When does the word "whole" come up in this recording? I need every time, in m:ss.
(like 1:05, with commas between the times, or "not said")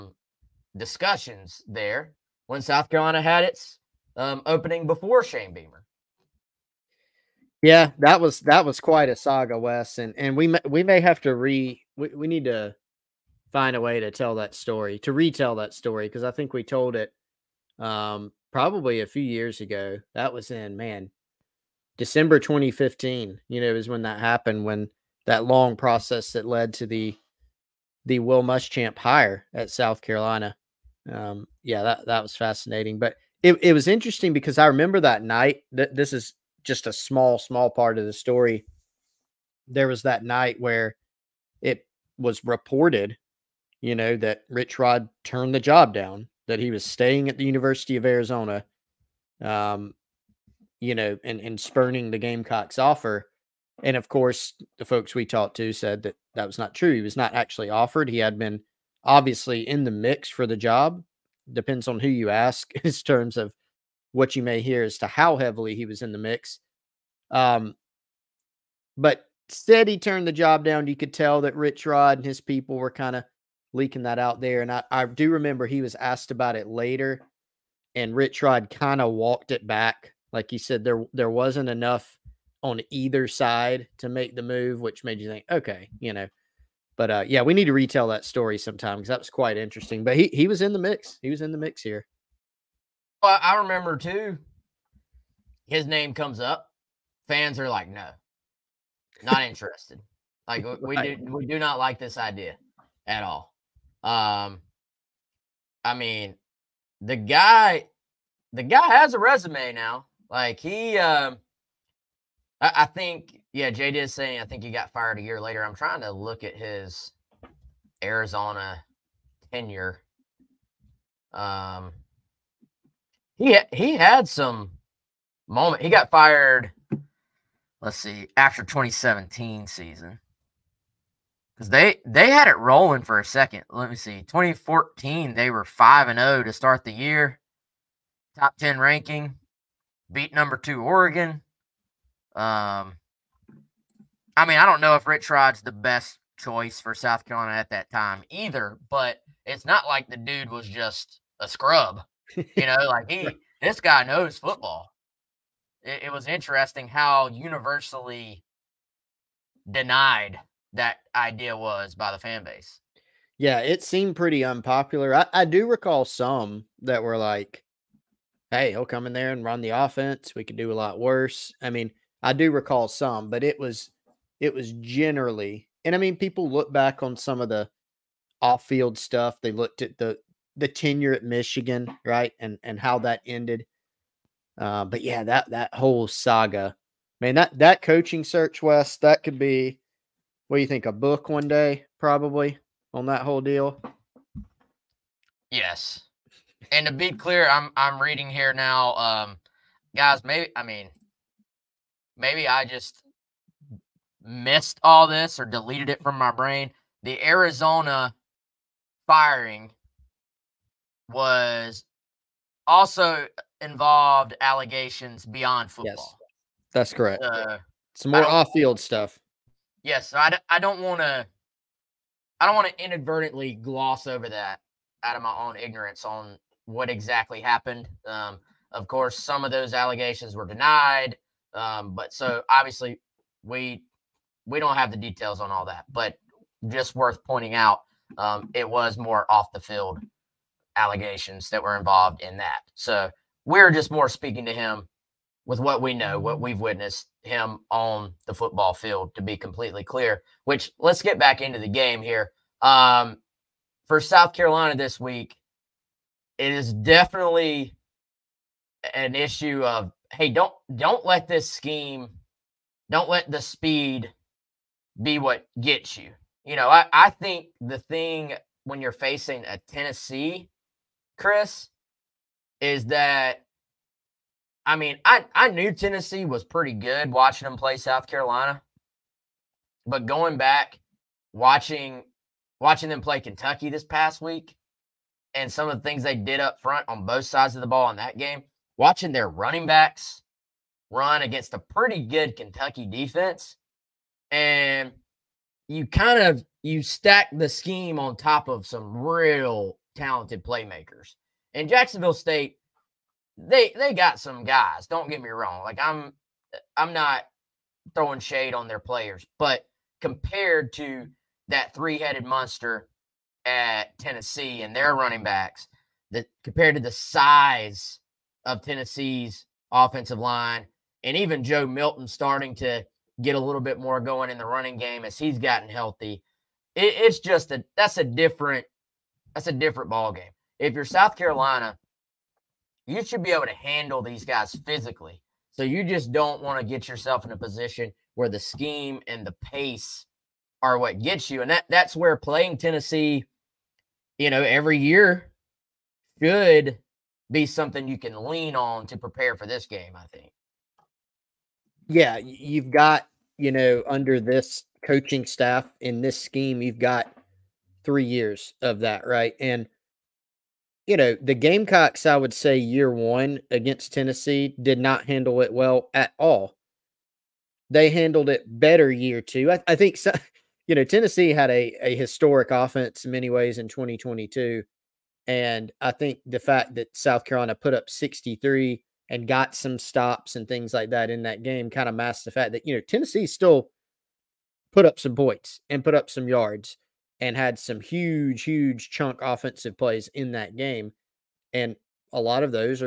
3:05, 3:13.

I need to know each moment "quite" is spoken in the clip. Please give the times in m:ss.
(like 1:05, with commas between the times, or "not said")
0:08, 1:29.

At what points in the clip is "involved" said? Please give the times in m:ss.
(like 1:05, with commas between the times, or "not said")
3:33, 4:01.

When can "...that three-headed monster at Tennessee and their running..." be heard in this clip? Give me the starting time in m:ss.
5:11.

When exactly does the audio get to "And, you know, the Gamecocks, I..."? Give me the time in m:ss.
5:59.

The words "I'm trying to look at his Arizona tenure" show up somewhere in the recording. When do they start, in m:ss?
1:55.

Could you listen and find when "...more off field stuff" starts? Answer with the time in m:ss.
3:38.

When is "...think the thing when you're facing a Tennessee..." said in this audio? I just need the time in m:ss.
4:27.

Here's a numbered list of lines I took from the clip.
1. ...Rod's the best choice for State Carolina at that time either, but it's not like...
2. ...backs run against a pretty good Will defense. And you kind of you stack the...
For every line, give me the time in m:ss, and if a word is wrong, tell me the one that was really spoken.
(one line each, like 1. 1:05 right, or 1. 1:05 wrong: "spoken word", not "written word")
1. 2:25 wrong: "South", not "State"
2. 4:49 wrong: "Kentucky", not "Will".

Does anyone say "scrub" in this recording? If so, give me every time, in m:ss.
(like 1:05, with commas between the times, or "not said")
2:31.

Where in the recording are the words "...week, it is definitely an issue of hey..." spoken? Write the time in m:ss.
4:14.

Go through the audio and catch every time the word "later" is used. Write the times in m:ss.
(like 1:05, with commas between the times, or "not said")
1:16, 1:55.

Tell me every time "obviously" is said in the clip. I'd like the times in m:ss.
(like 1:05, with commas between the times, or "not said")
0:59, 3:52.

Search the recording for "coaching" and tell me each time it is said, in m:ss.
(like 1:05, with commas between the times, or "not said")
3:07, 5:54.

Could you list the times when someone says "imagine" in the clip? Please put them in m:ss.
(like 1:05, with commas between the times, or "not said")
not said.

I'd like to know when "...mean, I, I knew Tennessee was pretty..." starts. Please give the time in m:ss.
4:34.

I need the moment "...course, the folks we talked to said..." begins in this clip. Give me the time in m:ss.
0:54.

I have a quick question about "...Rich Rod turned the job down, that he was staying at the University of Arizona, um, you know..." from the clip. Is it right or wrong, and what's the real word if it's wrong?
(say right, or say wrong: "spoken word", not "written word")
right.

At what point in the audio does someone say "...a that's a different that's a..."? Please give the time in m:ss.
5:27.